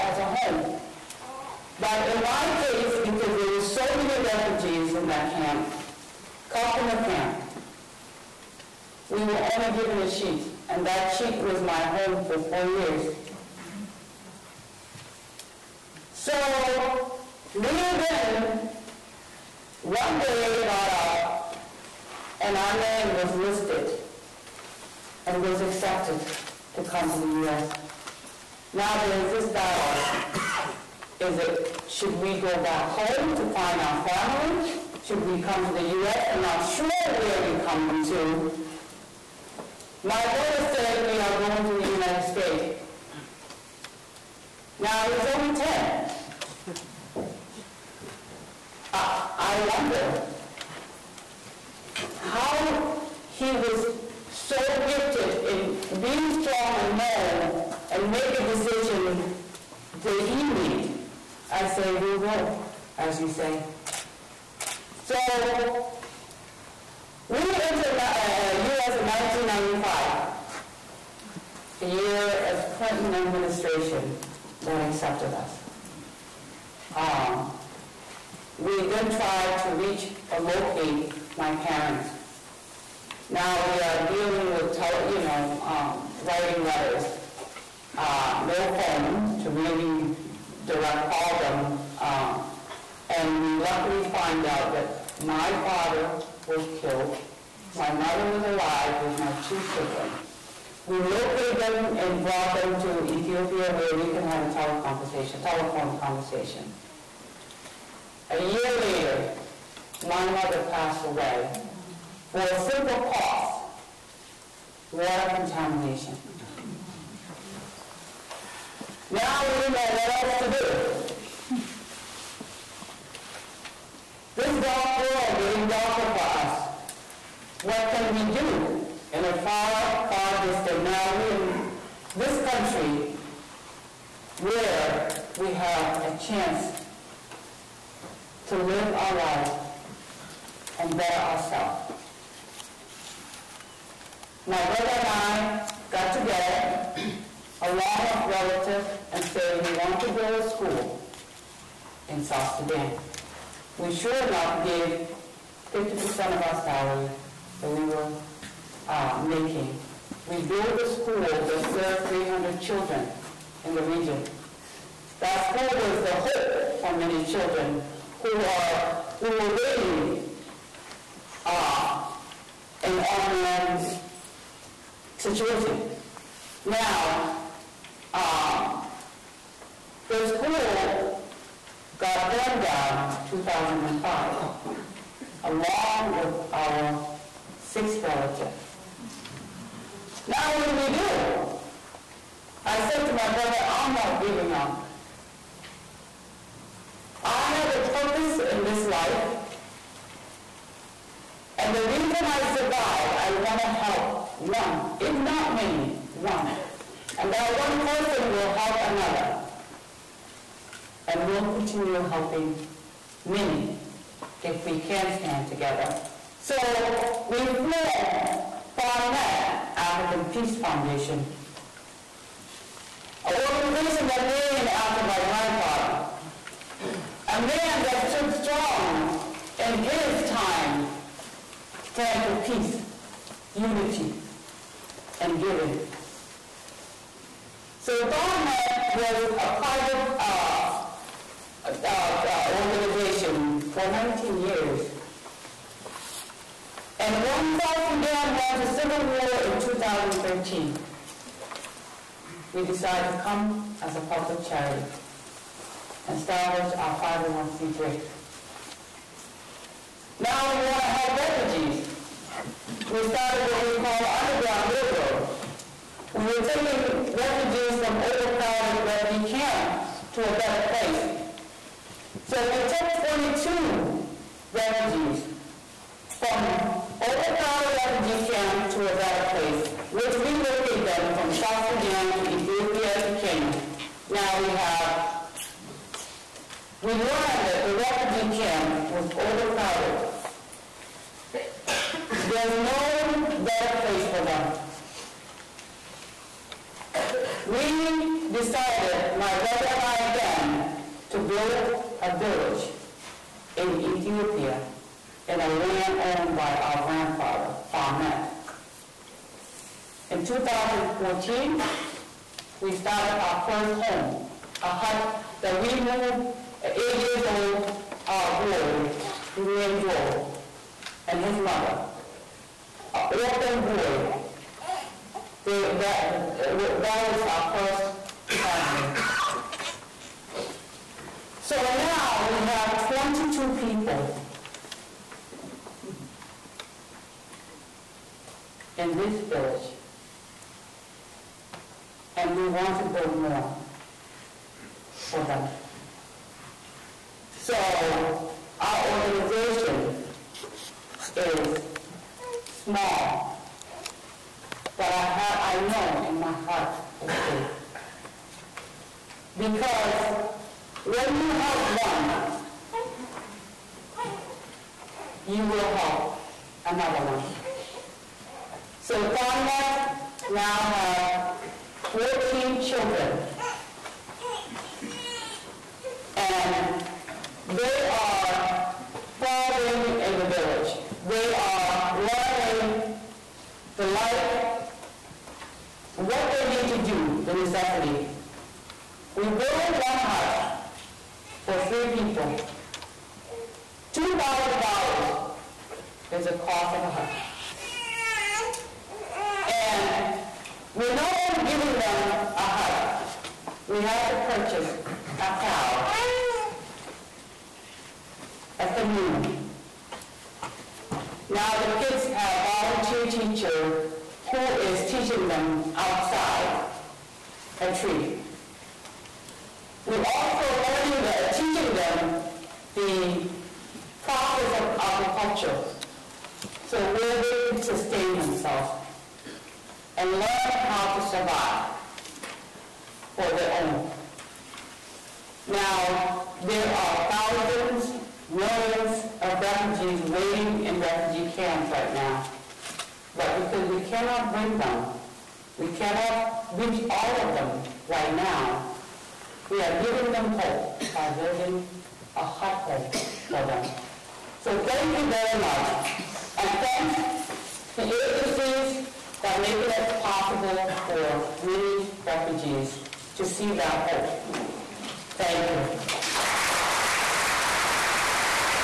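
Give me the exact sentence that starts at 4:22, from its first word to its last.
We started what we call Underground Railroad.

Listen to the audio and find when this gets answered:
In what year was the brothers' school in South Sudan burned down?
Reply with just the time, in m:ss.
3:03.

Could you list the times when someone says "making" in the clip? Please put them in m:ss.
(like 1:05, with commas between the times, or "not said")
2:39, 7:39.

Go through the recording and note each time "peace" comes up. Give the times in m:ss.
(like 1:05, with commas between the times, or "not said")
3:40, 3:52.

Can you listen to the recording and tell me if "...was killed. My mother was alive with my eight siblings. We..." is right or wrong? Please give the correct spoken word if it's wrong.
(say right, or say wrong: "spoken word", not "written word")
wrong: "two", not "eight".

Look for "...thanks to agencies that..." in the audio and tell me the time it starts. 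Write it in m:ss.
7:36.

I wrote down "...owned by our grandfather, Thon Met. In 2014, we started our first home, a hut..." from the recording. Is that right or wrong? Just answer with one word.
right.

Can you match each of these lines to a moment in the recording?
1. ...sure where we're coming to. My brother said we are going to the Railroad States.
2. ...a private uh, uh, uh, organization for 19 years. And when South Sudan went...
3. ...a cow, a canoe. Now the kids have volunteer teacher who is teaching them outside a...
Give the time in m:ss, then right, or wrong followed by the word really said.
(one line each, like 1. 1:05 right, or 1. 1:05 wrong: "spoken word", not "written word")
1. 0:36 wrong: "United", not "Railroad"
2. 3:59 right
3. 6:45 right.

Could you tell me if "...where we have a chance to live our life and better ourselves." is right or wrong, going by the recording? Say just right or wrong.
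right.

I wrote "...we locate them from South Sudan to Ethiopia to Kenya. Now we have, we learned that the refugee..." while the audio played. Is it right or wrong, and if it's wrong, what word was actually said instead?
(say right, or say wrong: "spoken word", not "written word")
right.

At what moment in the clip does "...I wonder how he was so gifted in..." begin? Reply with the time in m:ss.
0:49.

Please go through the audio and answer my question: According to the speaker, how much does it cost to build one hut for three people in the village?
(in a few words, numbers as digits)
$2,000.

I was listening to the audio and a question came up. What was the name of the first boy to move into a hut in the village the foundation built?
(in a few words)
Joel.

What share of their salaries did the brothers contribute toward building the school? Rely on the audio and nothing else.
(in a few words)
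50%.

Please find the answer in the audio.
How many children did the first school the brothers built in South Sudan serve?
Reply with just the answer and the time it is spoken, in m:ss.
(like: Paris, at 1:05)
300, at 2:42.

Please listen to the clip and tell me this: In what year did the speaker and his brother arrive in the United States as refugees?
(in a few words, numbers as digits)
1995.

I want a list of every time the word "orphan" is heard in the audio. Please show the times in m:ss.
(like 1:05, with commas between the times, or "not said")
5:23.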